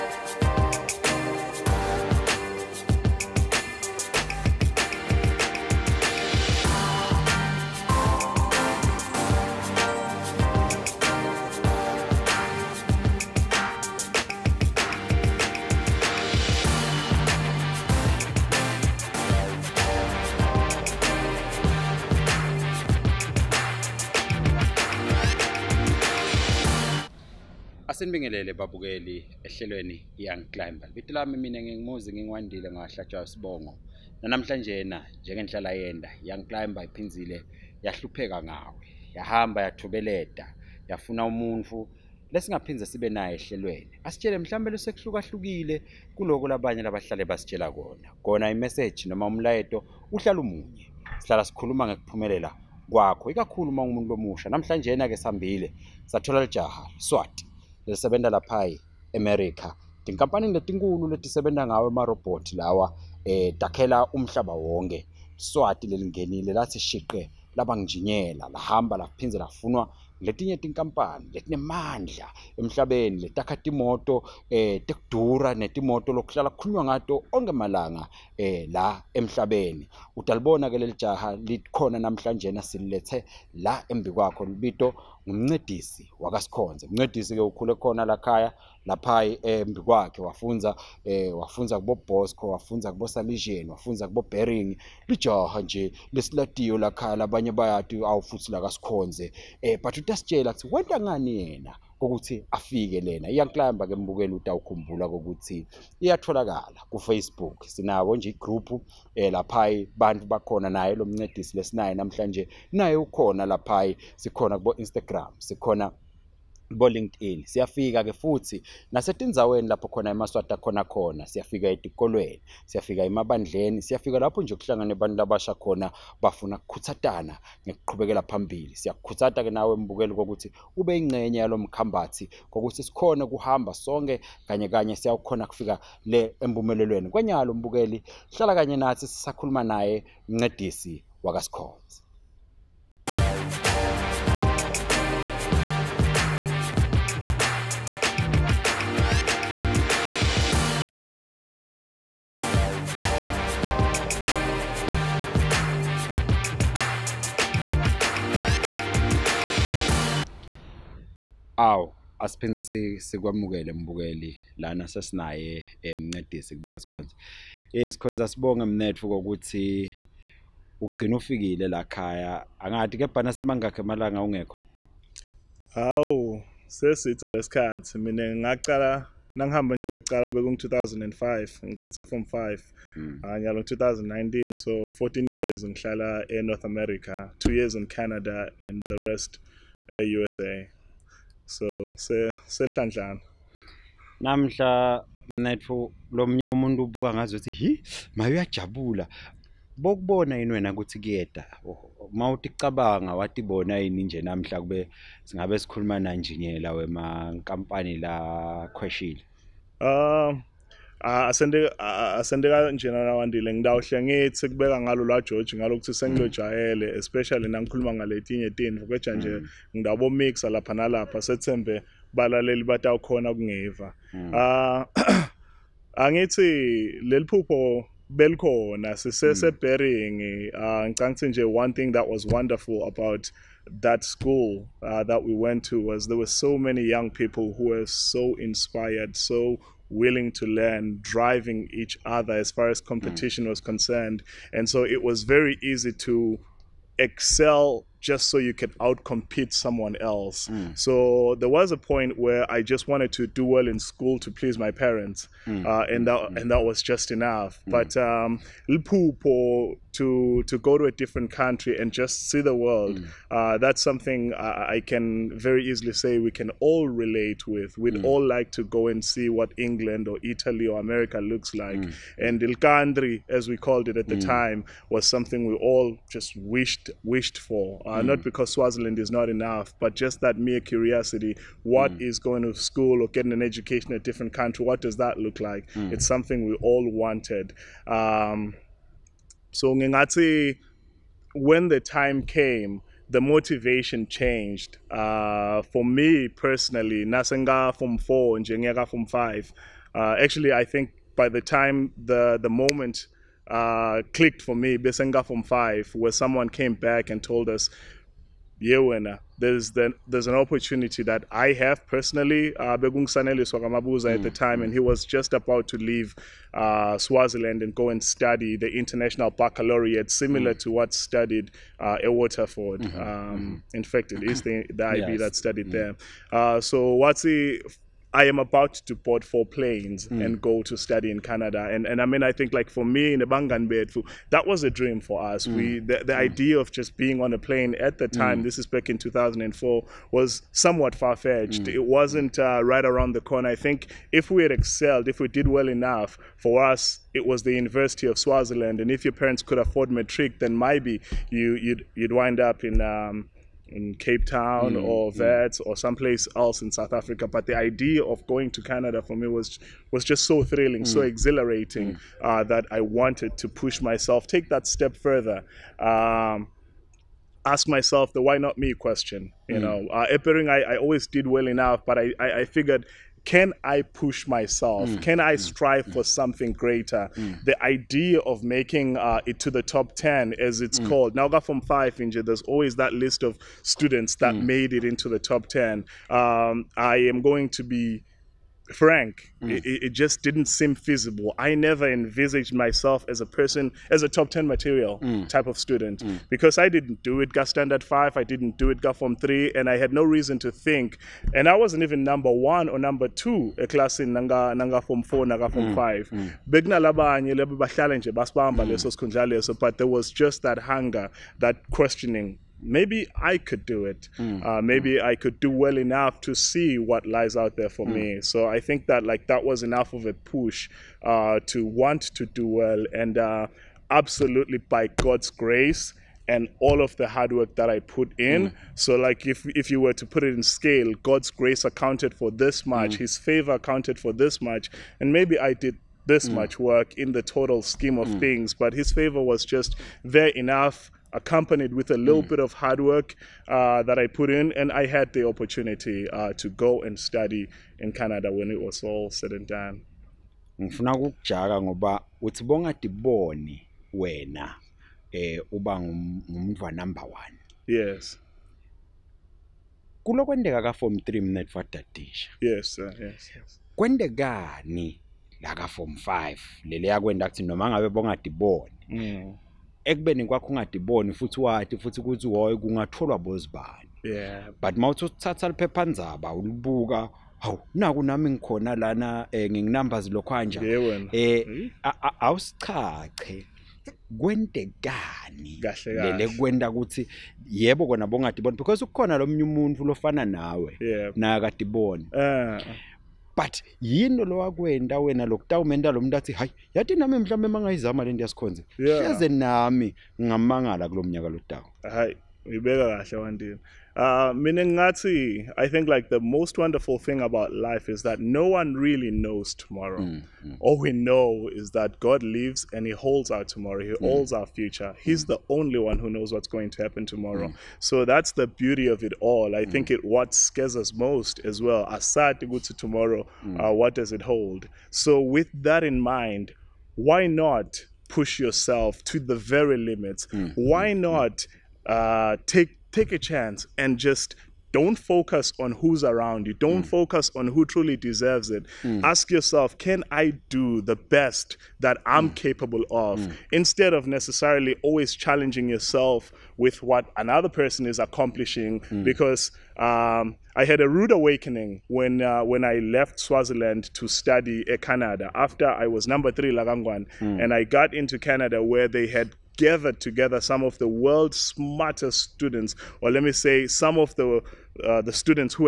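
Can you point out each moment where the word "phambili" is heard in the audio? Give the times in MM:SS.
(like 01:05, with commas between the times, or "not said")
02:08.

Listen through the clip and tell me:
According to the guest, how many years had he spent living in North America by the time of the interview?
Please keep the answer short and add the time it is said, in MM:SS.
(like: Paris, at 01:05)
14 years, at 03:04.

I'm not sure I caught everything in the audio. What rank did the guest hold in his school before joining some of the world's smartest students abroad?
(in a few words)
number three.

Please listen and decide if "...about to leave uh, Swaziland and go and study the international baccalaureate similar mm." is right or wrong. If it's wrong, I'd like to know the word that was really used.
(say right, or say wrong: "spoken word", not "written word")
right.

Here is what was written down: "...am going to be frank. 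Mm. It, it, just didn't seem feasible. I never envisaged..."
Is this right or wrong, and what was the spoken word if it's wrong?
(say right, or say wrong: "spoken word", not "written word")
right.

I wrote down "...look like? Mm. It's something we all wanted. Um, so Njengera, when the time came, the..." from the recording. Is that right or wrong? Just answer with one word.
wrong.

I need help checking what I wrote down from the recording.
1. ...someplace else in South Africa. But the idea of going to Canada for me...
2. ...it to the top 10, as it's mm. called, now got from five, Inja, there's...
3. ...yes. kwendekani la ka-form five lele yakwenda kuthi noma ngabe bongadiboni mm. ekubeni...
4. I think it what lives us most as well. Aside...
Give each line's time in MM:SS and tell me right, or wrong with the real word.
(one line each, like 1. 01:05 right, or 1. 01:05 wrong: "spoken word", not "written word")
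1. 05:55 right
2. 06:19 right
3. 07:43 right
4. 08:39 wrong: "scares", not "lives".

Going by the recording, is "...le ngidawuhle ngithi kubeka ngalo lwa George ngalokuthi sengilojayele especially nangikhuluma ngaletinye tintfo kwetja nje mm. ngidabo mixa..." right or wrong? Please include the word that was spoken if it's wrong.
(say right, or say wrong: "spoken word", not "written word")
right.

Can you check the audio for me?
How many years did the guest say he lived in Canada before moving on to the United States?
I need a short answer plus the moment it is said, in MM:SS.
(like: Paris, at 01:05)
2 years, at 03:07.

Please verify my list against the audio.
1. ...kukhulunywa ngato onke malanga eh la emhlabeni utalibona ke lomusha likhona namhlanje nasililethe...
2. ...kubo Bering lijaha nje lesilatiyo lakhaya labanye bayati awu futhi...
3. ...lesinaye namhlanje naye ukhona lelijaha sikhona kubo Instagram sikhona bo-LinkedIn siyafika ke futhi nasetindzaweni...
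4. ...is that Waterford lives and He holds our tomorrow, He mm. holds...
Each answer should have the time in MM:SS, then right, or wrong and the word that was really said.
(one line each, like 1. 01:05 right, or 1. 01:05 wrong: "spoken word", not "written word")
1. 01:16 wrong: "lelijaha", not "lomusha"
2. 01:34 right
3. 01:51 wrong: "lapha", not "lelijaha"
4. 08:31 wrong: "God", not "Waterford".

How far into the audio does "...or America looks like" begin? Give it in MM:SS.
04:30.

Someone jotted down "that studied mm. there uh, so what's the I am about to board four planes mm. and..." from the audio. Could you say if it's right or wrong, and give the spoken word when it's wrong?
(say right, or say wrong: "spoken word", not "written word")
right.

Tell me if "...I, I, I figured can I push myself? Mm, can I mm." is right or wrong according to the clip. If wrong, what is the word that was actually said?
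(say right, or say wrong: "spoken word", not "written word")
right.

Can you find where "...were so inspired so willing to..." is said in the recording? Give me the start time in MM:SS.
03:57.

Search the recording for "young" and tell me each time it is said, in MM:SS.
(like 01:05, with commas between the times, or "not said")
00:30, 00:36, 03:56.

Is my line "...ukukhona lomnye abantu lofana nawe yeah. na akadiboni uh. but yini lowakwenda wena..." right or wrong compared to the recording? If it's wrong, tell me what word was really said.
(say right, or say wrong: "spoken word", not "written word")
wrong: "umuntu", not "abantu".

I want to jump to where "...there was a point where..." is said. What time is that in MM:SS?
04:11.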